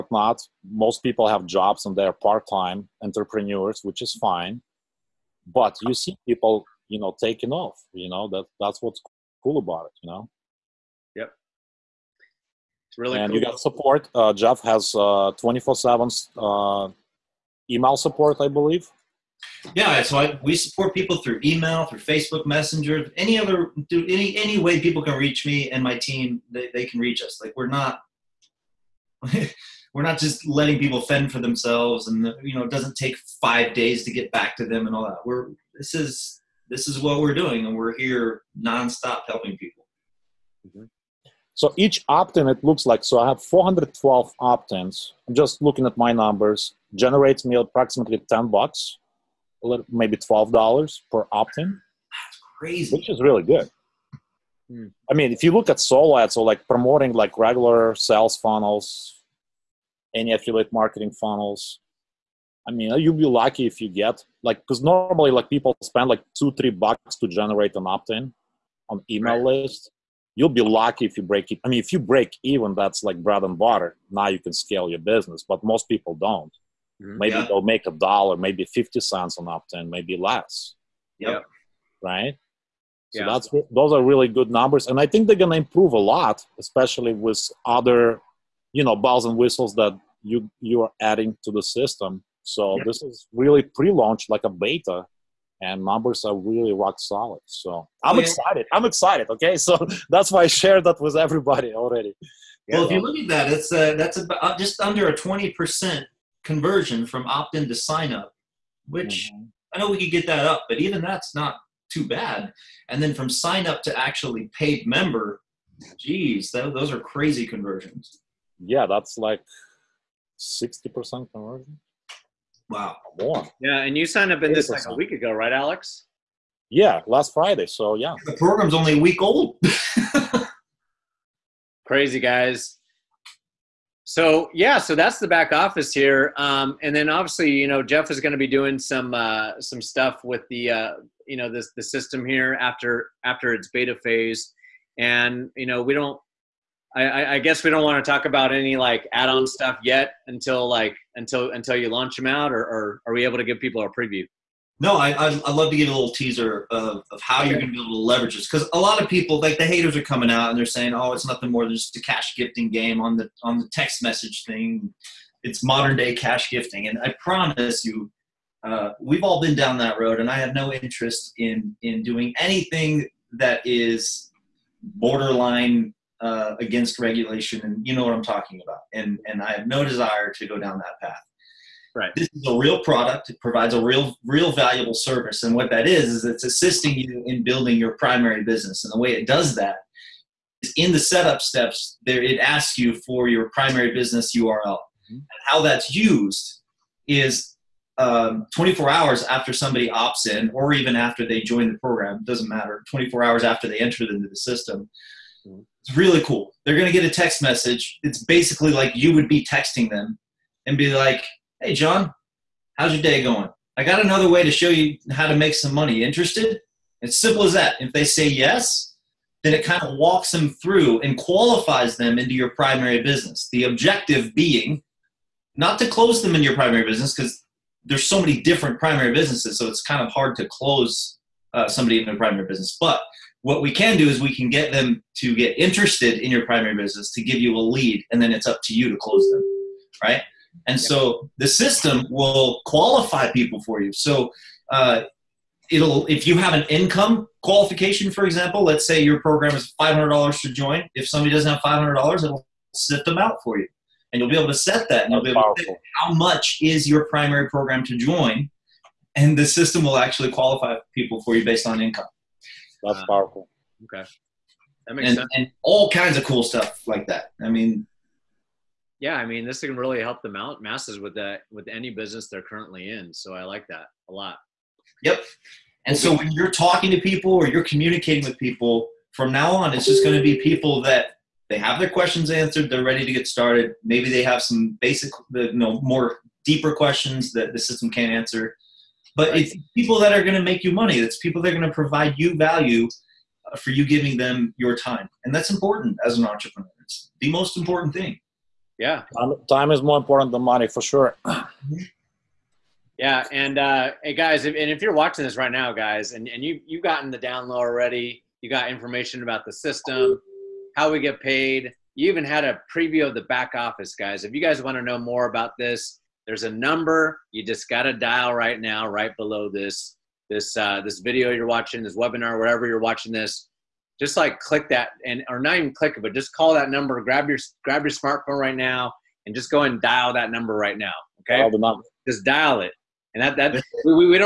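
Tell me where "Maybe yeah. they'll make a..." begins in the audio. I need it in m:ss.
1:17.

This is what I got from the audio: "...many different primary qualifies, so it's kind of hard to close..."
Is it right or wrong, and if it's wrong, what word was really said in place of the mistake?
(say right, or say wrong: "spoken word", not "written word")
wrong: "businesses", not "qualifies".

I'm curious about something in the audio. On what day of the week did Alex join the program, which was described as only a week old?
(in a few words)
Friday.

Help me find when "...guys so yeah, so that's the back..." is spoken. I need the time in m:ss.
2:12.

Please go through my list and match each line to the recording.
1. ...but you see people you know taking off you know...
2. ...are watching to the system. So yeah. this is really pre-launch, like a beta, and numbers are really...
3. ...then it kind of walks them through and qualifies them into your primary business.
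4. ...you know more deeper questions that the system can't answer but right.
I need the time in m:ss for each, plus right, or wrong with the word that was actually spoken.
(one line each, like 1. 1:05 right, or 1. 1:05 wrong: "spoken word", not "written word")
1. 0:05 right
2. 1:30 wrong: "adding", not "watching"
3. 3:39 right
4. 4:45 right.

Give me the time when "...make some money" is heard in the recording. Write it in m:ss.
3:35.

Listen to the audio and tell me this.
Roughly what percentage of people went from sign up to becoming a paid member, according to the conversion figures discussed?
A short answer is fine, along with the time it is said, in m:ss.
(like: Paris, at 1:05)
60%, at 2:00.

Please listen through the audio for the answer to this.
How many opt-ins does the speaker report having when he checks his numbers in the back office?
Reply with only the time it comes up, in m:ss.
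0:43.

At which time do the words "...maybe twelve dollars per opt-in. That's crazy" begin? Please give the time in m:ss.
0:49.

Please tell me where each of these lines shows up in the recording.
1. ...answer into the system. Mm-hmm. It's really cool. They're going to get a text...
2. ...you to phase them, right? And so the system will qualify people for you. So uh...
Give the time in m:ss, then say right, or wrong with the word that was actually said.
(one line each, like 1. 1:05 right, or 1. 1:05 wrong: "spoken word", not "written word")
1. 3:23 wrong: "enter", not "answer"
2. 3:58 wrong: "close", not "phase".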